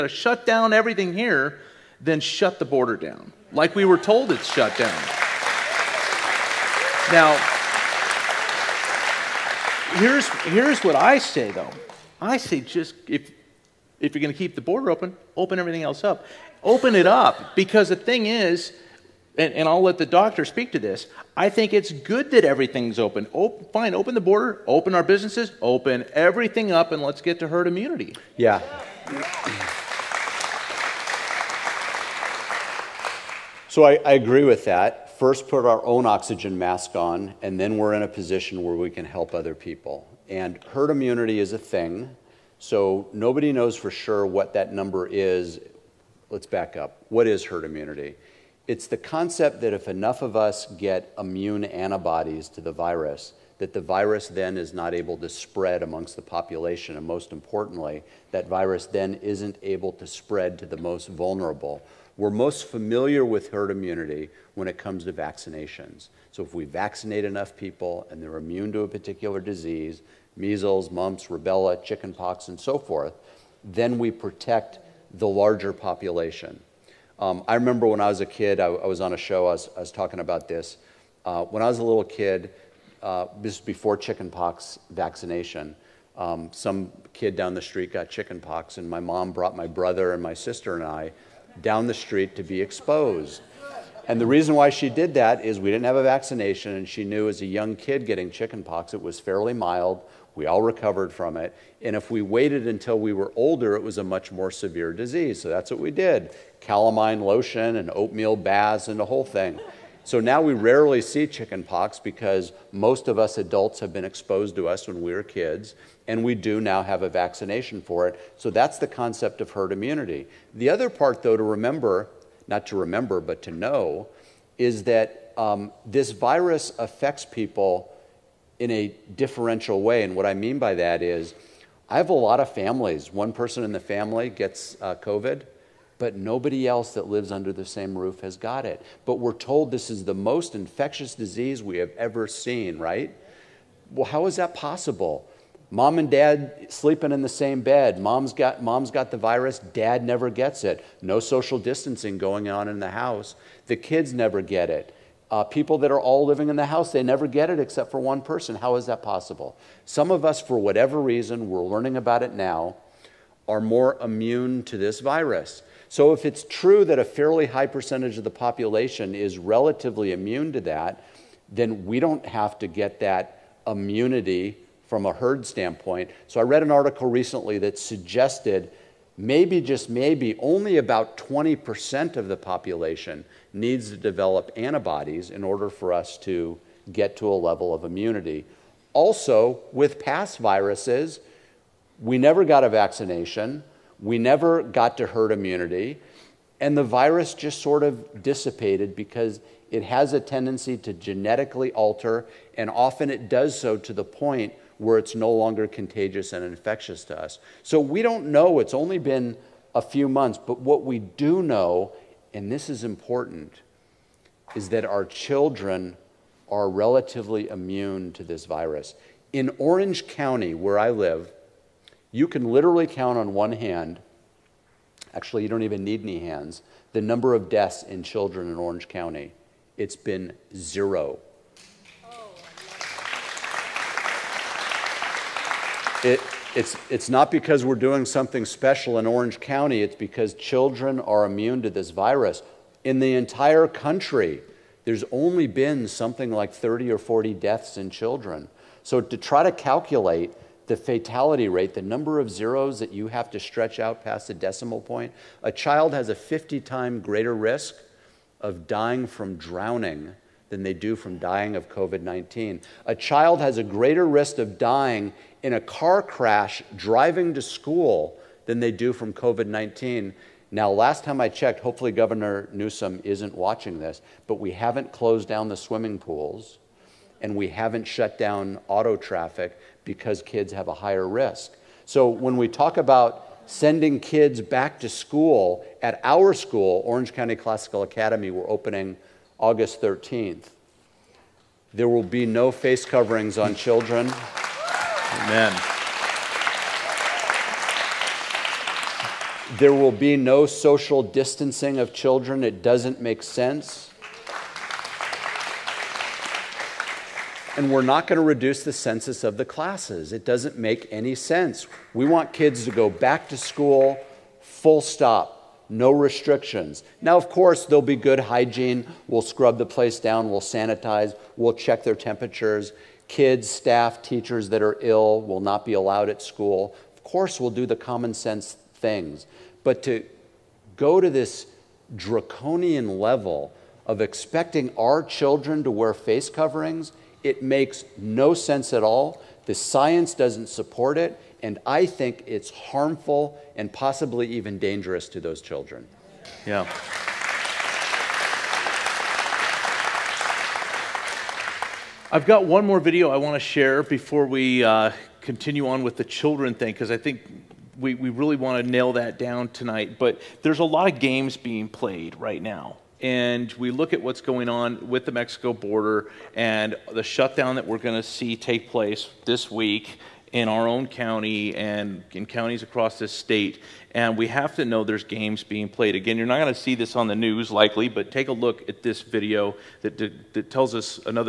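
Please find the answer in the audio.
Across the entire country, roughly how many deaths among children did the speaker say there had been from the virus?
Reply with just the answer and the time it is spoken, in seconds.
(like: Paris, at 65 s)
30 or 40, at 246 s.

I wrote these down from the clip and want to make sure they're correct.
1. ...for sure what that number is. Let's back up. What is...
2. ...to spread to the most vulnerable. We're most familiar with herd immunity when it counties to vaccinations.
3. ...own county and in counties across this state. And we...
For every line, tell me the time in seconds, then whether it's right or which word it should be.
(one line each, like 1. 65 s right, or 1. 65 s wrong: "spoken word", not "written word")
1. 43 s right
2. 59 s wrong: "comes", not "counties"
3. 370 s right.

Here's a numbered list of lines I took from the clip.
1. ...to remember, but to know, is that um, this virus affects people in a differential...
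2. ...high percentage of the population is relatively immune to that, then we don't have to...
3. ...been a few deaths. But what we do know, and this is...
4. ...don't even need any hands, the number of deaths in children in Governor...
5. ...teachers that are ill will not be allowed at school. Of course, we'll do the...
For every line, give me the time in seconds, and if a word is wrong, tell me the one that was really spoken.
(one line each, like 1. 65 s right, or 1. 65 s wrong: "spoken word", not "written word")
1. 122 s right
2. 167 s right
3. 208 s wrong: "months", not "deaths"
4. 225 s wrong: "Orange", not "Governor"
5. 324 s right.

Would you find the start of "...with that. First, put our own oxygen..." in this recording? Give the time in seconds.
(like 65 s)
34 s.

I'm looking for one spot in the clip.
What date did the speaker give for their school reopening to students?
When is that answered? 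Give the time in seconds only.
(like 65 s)
289 s.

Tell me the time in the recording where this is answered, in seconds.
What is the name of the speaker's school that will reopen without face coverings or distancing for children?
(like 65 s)
286 s.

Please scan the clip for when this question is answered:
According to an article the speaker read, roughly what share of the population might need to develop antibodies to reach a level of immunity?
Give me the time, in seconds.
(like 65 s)
181 s.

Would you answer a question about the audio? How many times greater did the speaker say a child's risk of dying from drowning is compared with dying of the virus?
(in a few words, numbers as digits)
50.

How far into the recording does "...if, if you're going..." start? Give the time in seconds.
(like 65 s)
13 s.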